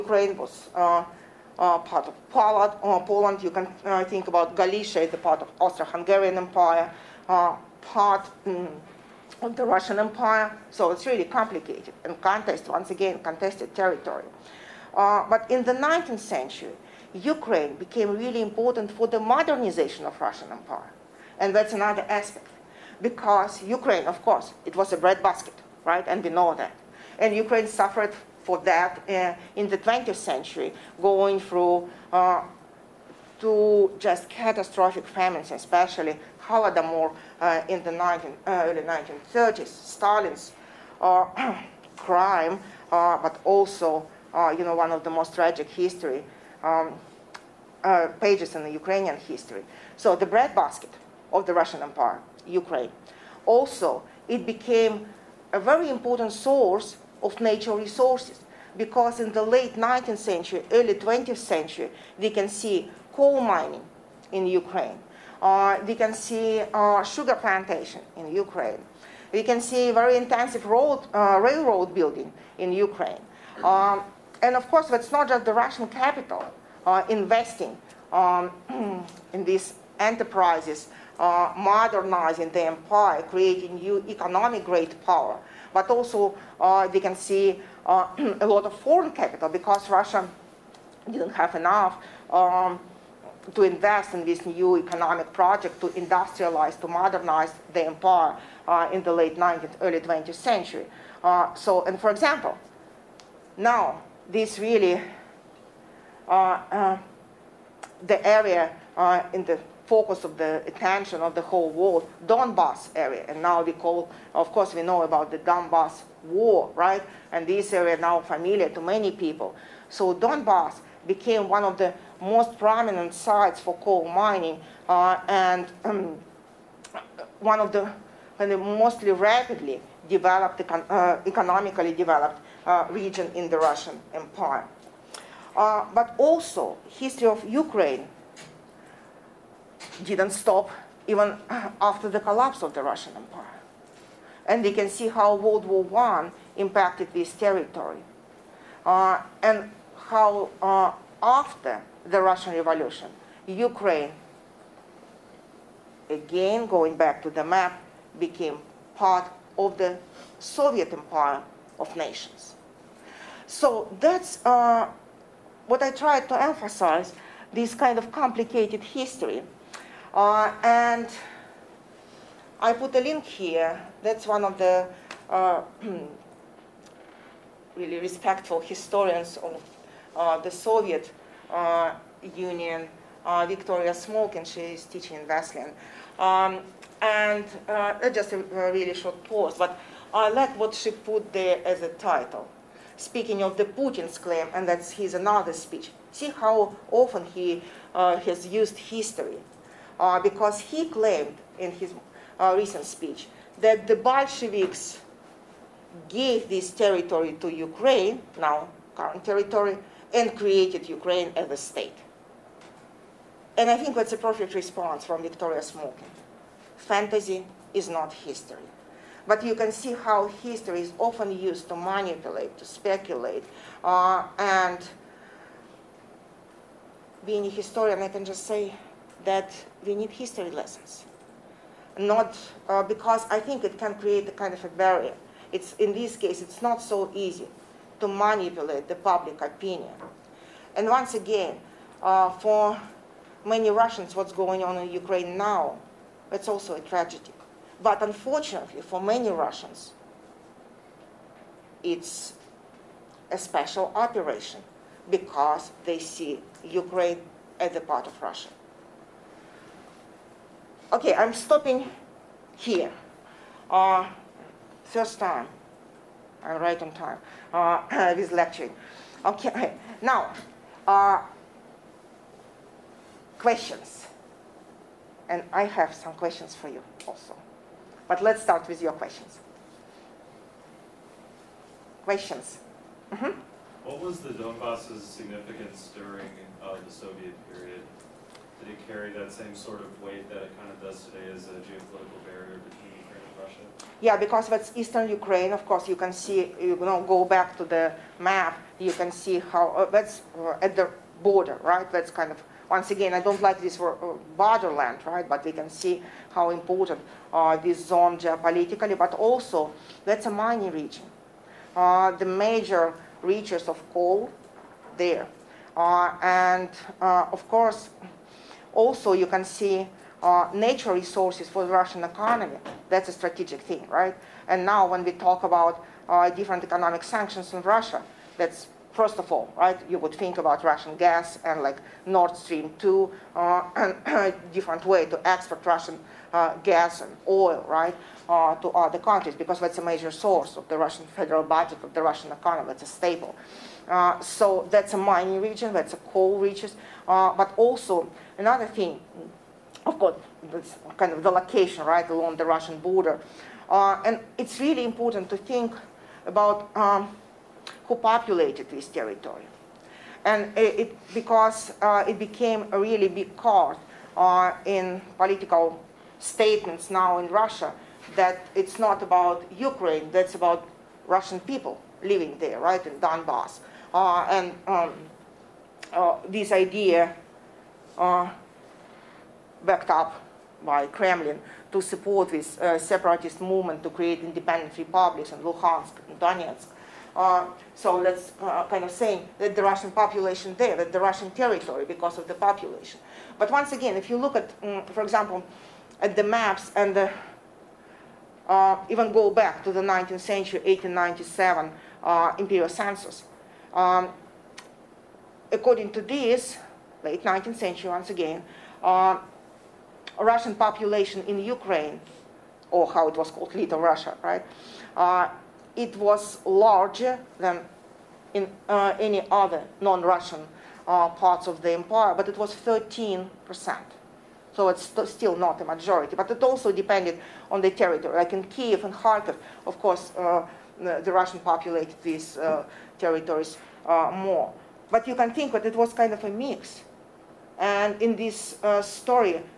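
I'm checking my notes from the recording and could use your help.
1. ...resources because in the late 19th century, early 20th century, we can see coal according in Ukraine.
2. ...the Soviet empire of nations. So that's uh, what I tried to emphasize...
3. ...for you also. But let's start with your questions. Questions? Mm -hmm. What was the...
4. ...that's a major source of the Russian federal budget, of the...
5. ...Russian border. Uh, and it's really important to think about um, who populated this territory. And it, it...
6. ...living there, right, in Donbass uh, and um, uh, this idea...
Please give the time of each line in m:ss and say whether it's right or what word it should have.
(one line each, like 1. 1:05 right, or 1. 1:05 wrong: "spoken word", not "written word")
1. 0:57 wrong: "mining", not "according"
2. 2:39 right
3. 4:36 right
4. 5:39 right
5. 5:52 right
6. 6:12 right.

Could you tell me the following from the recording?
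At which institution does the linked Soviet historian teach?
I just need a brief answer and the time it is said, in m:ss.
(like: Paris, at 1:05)
Wesleyan, at 3:05.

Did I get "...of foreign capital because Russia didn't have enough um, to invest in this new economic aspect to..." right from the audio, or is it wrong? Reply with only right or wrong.
wrong.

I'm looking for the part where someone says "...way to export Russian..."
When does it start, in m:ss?
5:34.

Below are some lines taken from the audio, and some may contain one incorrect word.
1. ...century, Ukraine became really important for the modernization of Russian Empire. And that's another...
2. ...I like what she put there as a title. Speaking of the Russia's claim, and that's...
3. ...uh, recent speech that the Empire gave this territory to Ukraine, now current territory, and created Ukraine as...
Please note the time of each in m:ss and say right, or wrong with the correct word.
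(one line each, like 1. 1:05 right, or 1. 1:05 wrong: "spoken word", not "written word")
1. 0:16 right
2. 3:10 wrong: "Putin", not "Russia"
3. 3:22 wrong: "Bolsheviks", not "Empire".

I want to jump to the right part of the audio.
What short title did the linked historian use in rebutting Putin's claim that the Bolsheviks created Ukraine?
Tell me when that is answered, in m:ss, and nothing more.
3:36.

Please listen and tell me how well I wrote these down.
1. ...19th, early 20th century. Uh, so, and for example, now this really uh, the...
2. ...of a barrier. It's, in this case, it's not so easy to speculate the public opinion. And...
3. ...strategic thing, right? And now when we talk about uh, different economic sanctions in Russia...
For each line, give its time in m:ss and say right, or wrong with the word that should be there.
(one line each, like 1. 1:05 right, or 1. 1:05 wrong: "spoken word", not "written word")
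1. 1:39 right
2. 3:54 wrong: "manipulate", not "speculate"
3. 5:23 right.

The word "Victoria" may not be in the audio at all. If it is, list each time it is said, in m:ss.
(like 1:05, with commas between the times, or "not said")
3:03, 3:35.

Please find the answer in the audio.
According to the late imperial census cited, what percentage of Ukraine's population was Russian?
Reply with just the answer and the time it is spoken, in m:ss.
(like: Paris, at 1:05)
13%, at 7:02.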